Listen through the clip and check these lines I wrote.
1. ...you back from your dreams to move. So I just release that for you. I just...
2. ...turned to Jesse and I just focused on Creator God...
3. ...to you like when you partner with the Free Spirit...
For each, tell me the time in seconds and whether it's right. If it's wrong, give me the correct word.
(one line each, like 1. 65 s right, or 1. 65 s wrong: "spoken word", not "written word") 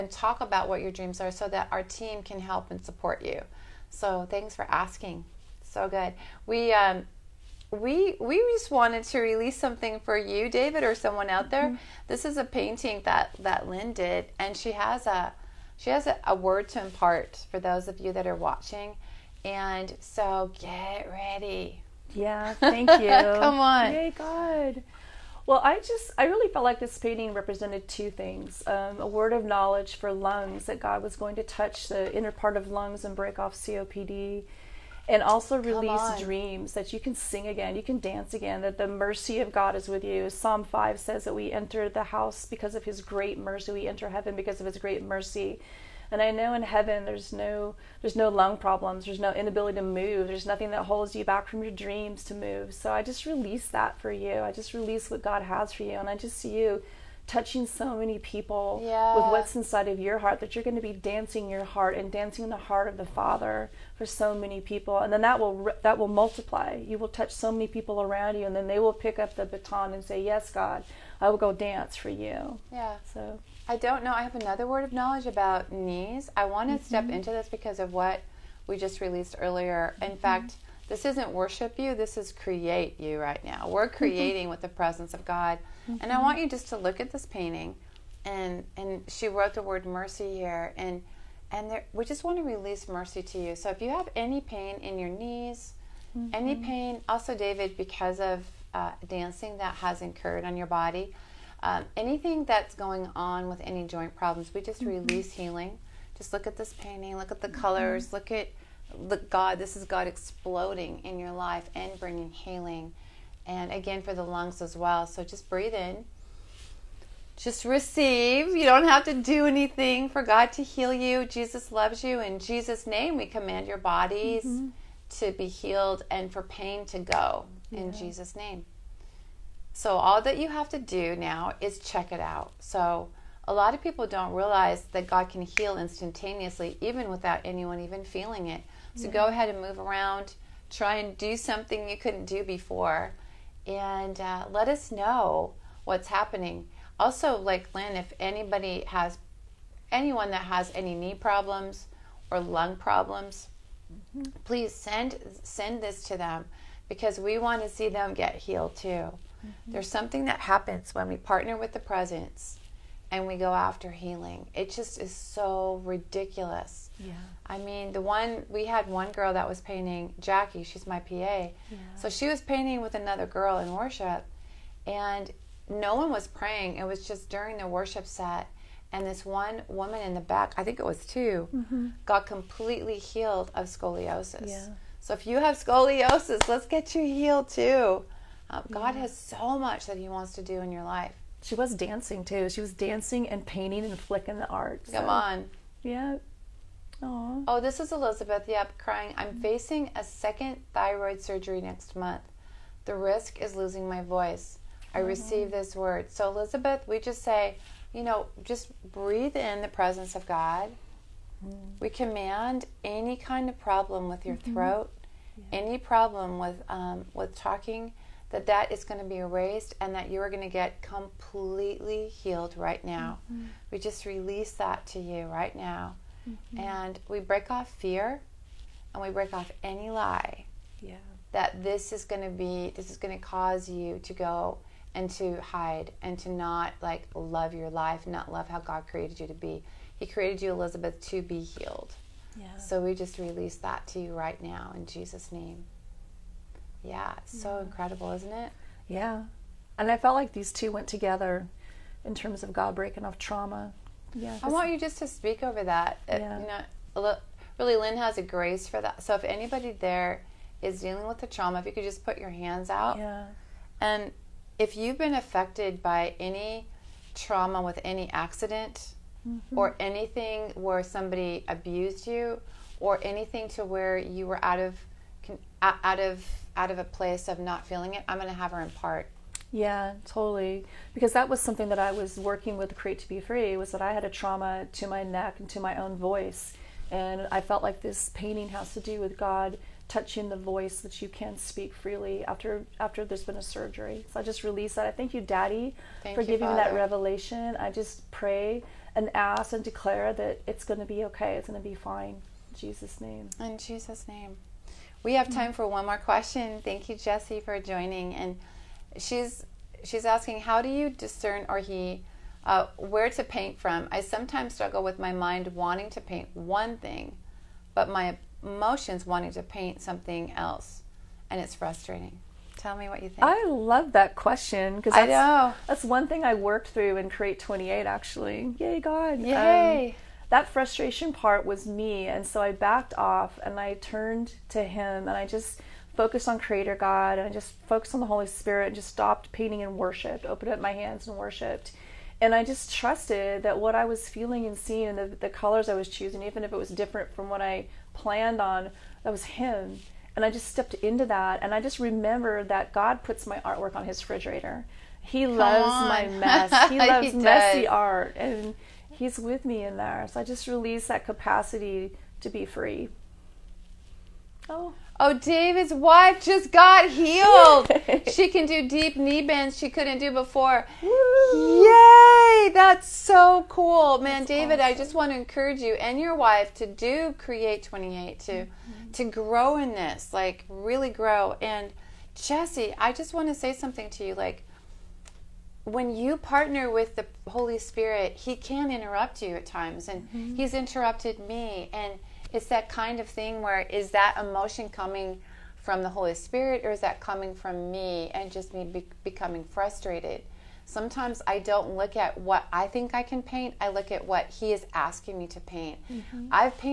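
1. 51 s right
2. 333 s wrong: "Him", not "Jesse"
3. 383 s wrong: "Holy", not "Free".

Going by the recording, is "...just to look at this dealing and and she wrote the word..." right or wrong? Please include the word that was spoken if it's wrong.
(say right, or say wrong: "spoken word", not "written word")
wrong: "painting", not "dealing".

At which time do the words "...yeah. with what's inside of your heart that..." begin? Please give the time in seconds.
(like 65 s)
58 s.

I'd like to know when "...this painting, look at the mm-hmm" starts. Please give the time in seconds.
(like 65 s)
106 s.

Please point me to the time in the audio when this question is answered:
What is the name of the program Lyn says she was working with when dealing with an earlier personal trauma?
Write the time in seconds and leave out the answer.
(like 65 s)
282 s.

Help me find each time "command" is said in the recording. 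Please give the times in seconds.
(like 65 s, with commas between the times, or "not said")
123 s, 211 s.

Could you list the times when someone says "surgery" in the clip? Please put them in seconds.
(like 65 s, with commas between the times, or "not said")
201 s, 293 s.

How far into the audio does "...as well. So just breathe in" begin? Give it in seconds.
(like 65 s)
114 s.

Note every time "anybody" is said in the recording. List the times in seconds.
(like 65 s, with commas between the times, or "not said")
148 s, 259 s.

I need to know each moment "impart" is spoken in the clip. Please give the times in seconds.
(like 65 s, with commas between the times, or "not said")
16 s, 278 s.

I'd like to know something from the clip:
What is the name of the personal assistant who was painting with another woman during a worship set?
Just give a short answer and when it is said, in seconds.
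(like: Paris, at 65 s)
Jackie, at 170 s.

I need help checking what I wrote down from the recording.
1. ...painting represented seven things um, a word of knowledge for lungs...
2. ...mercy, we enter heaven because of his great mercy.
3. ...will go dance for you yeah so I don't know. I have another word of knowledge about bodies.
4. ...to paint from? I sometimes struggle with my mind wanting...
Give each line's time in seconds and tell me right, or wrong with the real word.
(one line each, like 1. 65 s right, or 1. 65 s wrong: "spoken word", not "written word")
1. 26 s wrong: "two", not "seven"
2. 43 s right
3. 71 s wrong: "knees", not "bodies"
4. 313 s right.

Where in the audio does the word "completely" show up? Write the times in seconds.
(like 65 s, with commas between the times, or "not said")
182 s, 220 s.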